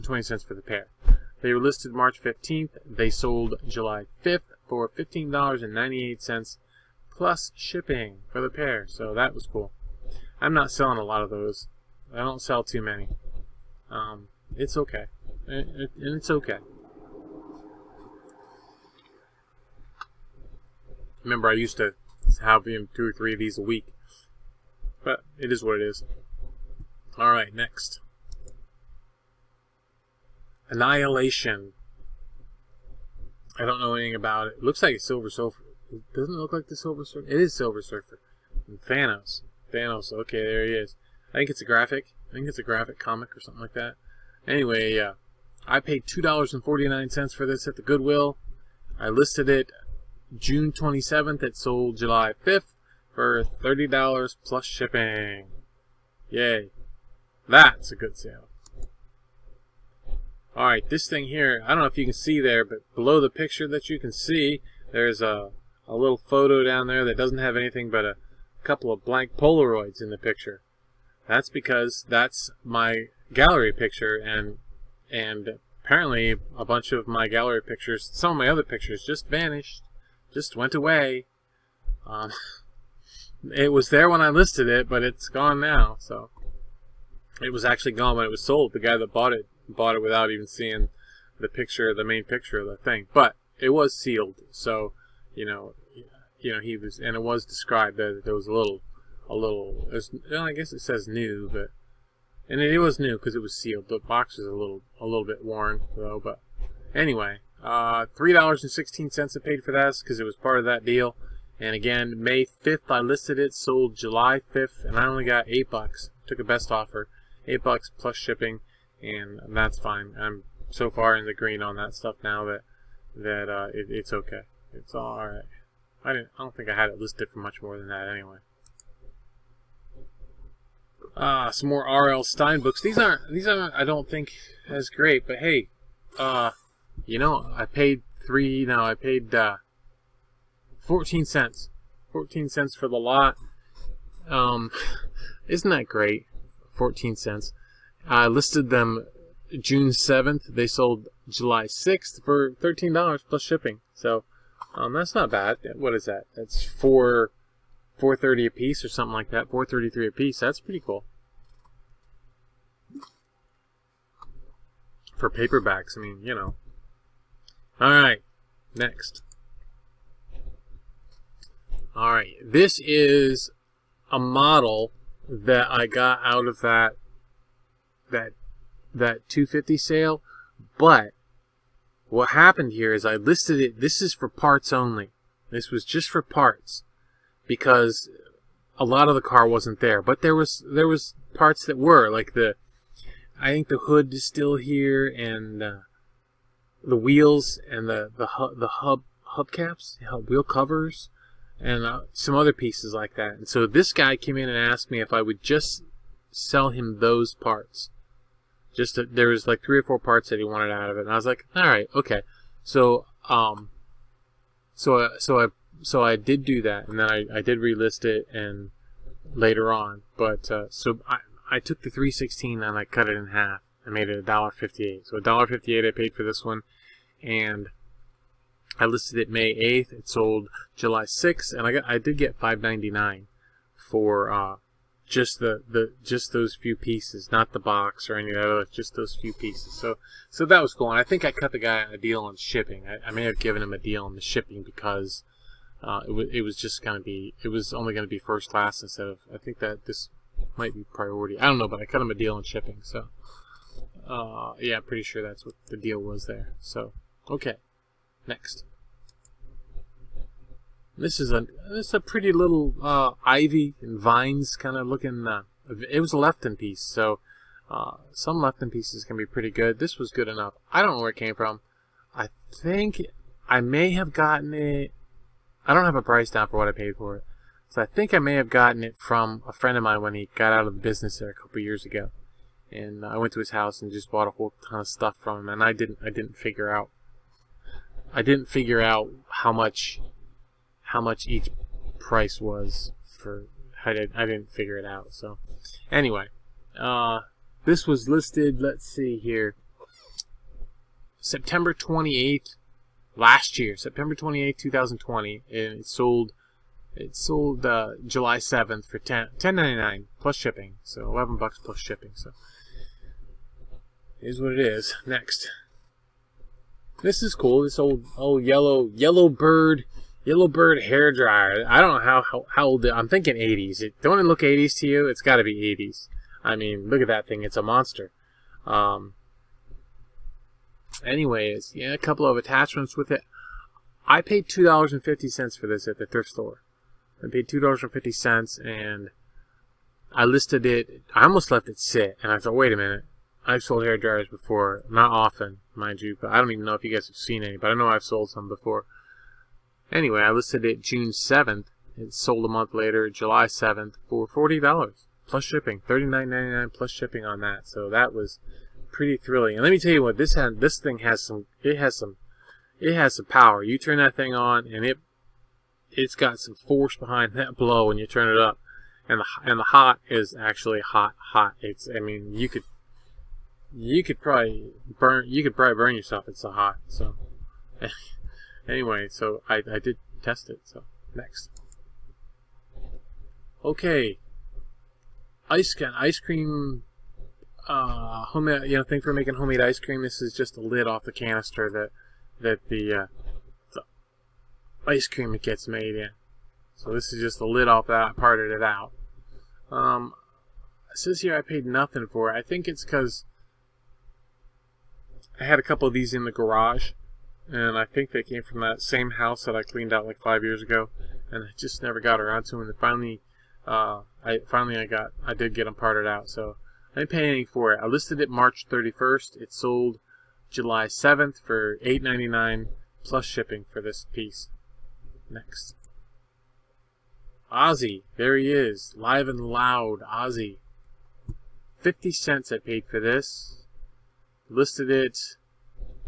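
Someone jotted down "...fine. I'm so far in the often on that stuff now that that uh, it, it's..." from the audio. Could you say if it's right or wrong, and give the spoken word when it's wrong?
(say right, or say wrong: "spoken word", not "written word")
wrong: "green", not "often".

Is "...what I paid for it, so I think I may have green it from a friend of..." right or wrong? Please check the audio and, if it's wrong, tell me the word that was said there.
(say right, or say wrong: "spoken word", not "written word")
wrong: "gotten", not "green".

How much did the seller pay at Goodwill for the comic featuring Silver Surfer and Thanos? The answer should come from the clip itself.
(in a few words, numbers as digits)
$2.49.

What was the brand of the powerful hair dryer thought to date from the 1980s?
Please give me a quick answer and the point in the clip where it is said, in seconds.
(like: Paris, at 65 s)
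Yellowbird, at 320 s.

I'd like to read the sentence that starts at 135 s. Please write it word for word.
But hey, uh, you know, I paid three.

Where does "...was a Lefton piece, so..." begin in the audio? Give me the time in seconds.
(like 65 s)
266 s.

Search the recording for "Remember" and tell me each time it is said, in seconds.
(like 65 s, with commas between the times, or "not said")
21 s.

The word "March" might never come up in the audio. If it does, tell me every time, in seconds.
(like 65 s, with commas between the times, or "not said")
1 s, 418 s.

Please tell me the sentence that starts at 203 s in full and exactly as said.
And so this guy came in and asked me if I would just sell him those parts.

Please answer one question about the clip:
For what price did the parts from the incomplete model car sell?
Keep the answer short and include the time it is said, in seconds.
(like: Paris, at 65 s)
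$5.99, at 232 s.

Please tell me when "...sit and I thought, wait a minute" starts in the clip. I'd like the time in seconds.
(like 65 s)
341 s.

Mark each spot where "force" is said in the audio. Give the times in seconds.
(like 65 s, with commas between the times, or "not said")
366 s.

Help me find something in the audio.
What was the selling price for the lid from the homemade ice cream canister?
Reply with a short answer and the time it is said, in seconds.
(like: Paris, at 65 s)
$8.99, at 421 s.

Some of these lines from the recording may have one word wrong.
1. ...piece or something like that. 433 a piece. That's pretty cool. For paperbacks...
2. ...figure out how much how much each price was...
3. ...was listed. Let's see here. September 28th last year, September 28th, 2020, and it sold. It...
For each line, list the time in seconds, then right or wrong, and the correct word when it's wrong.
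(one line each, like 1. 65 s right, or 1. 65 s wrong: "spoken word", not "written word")
1. 158 s right
2. 288 s right
3. 297 s right.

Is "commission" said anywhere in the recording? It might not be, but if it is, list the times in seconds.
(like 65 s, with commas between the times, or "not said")
not said.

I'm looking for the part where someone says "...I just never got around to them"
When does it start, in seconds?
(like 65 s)
411 s.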